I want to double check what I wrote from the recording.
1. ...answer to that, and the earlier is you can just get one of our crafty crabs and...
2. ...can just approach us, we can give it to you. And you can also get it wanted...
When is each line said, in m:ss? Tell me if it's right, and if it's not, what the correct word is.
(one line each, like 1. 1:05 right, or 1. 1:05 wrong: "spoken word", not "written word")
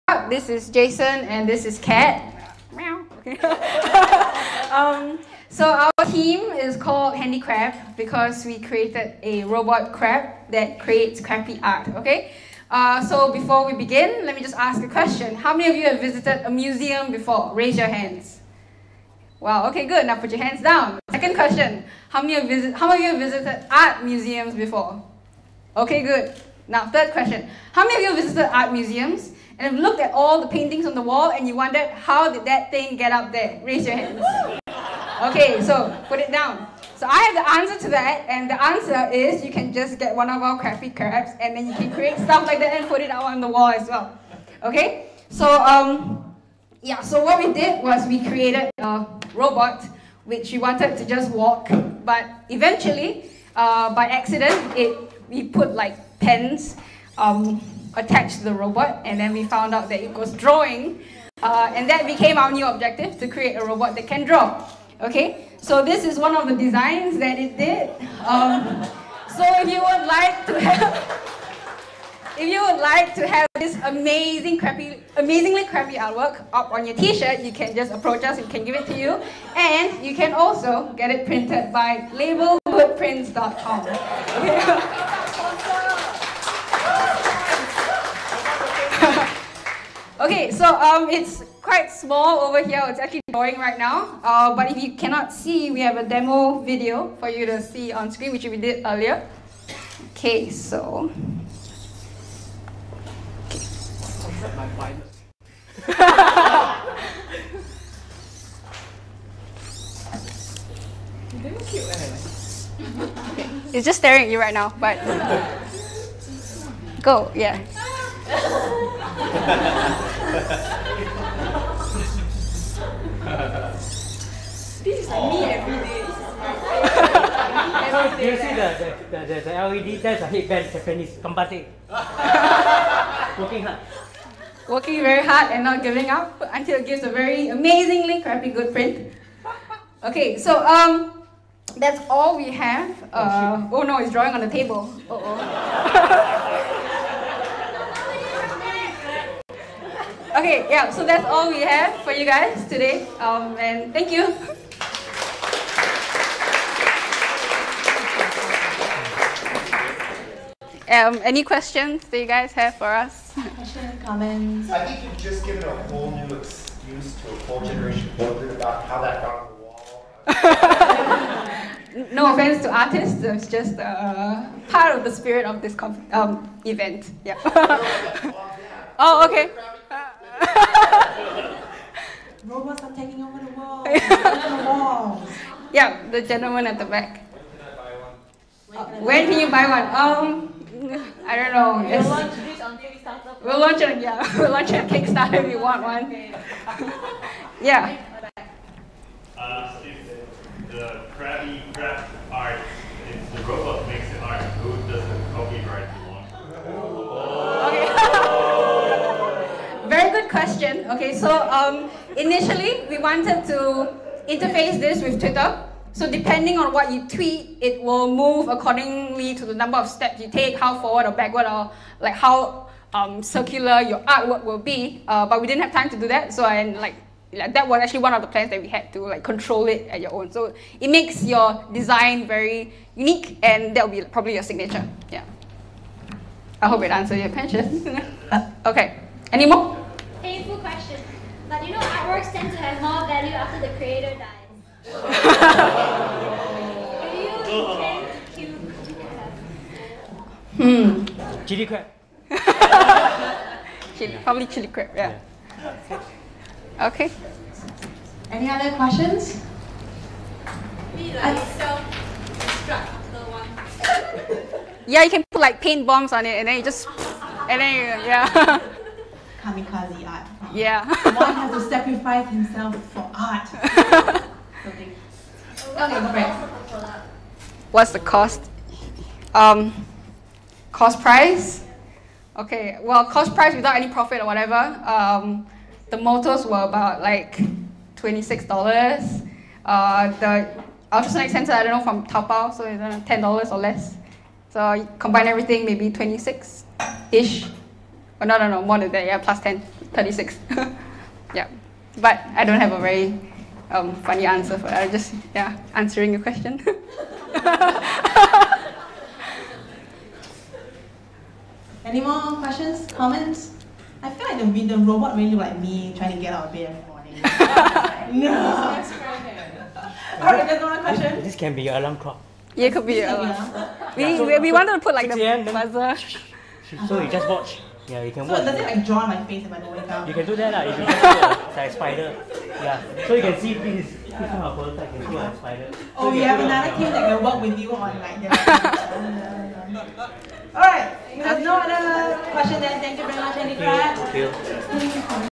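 1. 0:37 wrong: "answer", not "earlier"
2. 1:17 wrong: "printed", not "wanted".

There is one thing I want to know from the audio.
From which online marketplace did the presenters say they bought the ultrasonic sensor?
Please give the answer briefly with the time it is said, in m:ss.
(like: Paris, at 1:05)
Taobao, at 4:52.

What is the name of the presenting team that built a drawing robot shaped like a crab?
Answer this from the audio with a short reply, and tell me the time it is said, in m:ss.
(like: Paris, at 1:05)
Handicraft, at 0:07.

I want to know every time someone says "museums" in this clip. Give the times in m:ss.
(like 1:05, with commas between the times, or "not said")
0:16, 0:24, 0:28.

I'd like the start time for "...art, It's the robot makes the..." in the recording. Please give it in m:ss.
3:22.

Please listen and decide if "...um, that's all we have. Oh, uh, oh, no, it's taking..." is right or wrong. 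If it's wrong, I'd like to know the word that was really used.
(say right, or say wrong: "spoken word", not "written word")
wrong: "drawing", not "taking".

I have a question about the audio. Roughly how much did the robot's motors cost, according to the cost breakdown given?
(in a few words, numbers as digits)
$26.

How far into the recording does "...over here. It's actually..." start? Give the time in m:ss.
1:32.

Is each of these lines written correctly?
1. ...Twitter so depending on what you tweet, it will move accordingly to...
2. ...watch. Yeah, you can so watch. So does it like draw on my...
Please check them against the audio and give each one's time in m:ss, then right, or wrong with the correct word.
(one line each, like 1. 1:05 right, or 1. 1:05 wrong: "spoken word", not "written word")
1. 3:35 right
2. 5:27 right.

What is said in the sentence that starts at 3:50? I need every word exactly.
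So it makes your design very unique and that will be probably your signature.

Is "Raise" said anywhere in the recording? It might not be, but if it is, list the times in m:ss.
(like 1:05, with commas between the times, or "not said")
0:17, 0:33.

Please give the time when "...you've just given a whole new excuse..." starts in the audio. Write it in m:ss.
2:45.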